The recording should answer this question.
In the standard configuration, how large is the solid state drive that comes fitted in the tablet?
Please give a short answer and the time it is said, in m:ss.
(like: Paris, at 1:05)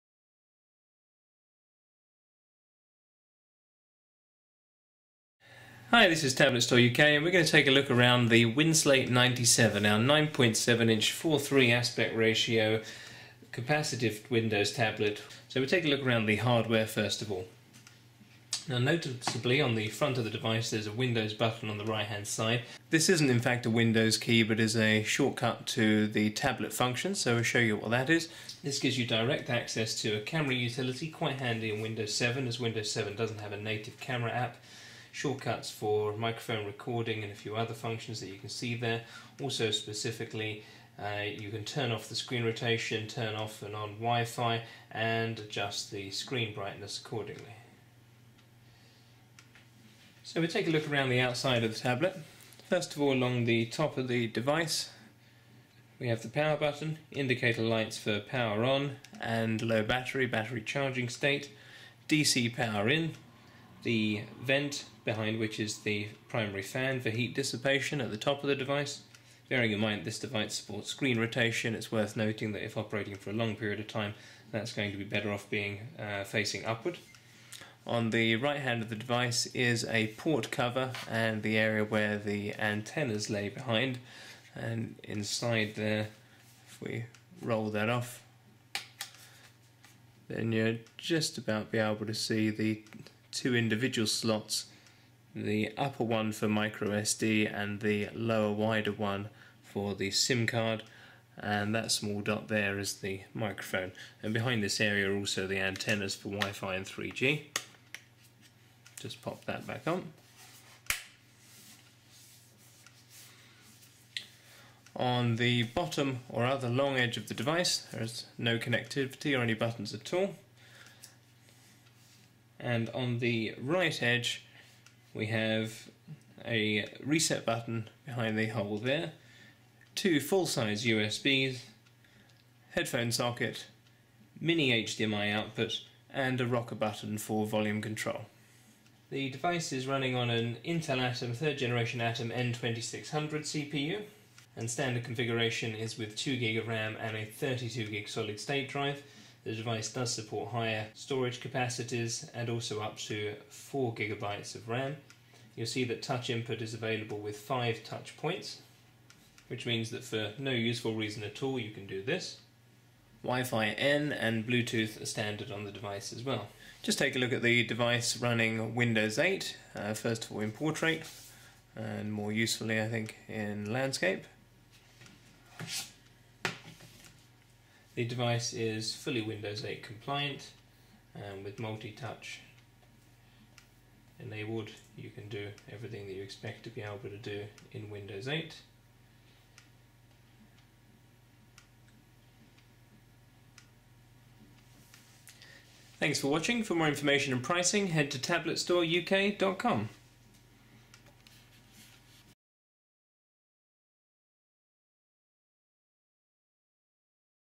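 32GB, at 2:27.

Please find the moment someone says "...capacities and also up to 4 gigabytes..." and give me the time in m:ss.
2:31.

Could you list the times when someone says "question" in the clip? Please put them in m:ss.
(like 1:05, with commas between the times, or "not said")
not said.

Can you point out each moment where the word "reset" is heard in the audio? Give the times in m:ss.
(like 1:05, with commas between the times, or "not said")
2:07.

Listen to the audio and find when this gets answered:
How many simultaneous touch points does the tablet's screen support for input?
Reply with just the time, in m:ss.
2:37.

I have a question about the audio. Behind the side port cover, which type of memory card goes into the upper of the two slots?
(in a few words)
micro SD.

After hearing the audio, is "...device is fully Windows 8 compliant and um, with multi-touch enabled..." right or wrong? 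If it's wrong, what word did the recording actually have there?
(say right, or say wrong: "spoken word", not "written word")
right.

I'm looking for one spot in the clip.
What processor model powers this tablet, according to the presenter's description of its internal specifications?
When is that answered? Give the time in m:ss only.
2:20.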